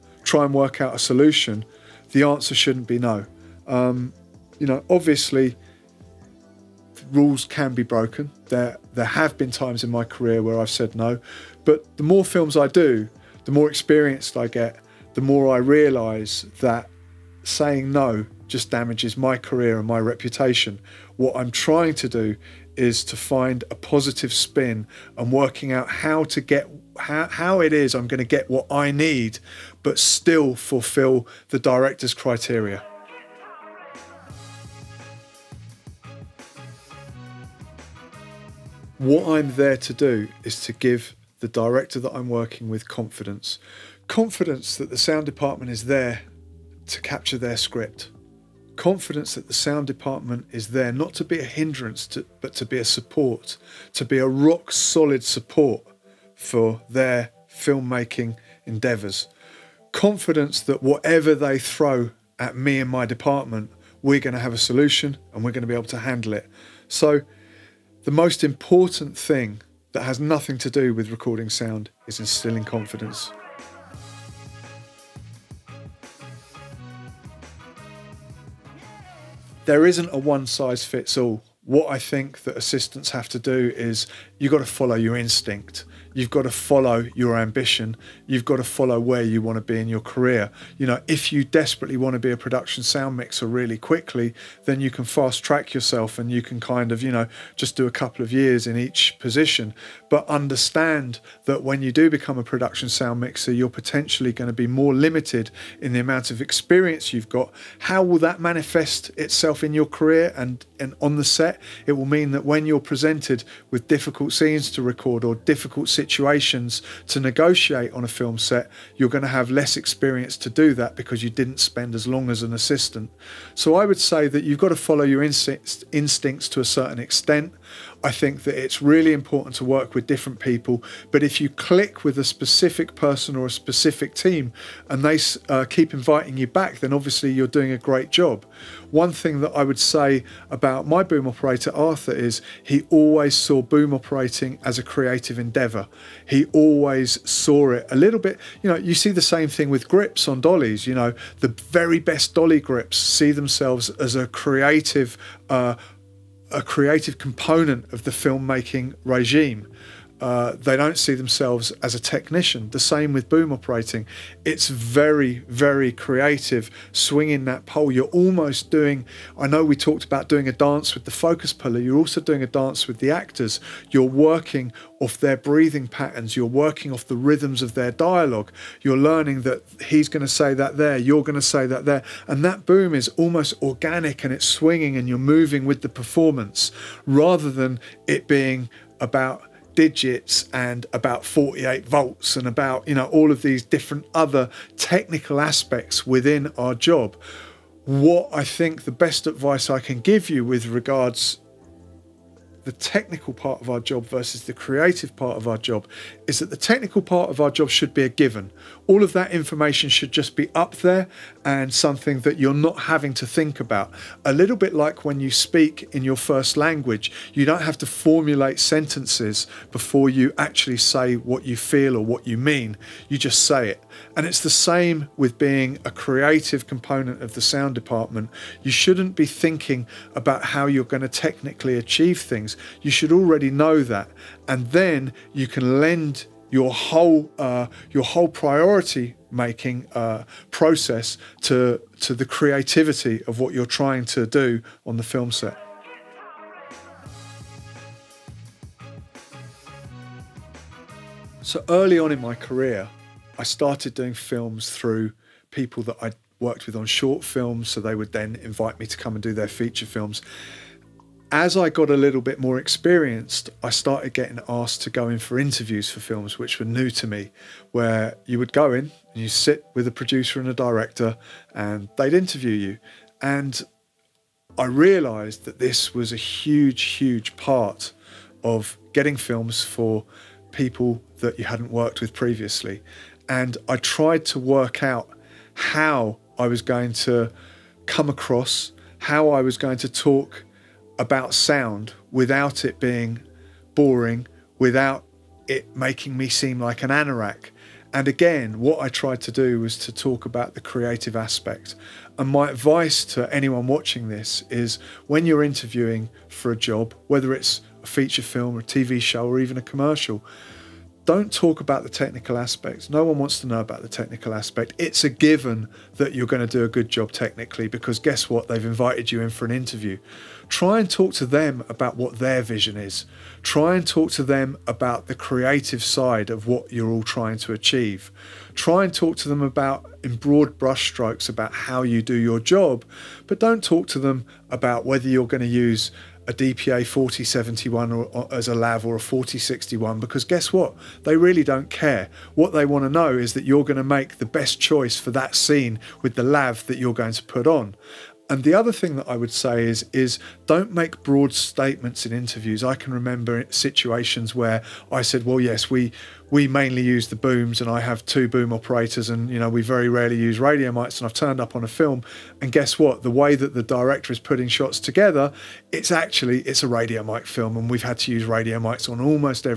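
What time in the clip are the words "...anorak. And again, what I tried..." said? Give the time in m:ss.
4:56.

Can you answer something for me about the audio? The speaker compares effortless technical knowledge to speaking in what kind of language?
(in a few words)
first language.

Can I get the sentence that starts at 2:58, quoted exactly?
You're learning that he's going to say that there, you're going to say that there.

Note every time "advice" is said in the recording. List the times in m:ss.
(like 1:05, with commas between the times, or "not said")
3:19, 5:02.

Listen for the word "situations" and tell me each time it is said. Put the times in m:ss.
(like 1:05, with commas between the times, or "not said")
1:55, 5:53.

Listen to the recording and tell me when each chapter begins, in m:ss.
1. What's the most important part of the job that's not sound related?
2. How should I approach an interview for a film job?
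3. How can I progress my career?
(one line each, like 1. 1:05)
1. 0:34
2. 4:06
3. 1:14.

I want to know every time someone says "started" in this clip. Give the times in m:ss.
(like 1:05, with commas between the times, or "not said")
4:13, 4:23.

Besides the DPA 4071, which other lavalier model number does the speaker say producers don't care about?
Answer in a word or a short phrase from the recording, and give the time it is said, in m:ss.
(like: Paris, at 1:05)
4061, at 5:38.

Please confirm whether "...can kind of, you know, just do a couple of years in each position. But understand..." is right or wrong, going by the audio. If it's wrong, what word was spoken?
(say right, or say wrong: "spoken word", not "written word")
right.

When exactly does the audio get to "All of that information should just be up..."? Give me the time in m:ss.
3:28.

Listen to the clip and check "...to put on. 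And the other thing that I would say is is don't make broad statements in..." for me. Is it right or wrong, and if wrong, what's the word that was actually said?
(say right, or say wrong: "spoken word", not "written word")
right.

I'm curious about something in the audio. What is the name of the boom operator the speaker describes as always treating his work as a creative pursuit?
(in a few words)
Arthur.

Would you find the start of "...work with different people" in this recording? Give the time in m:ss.
2:09.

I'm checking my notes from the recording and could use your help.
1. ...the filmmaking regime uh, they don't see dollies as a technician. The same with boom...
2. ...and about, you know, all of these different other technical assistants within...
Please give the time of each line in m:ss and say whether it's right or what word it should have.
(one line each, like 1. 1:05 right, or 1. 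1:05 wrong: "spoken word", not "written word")
1. 2:38 wrong: "themselves", not "dollies"
2. 3:12 wrong: "aspects", not "assistants".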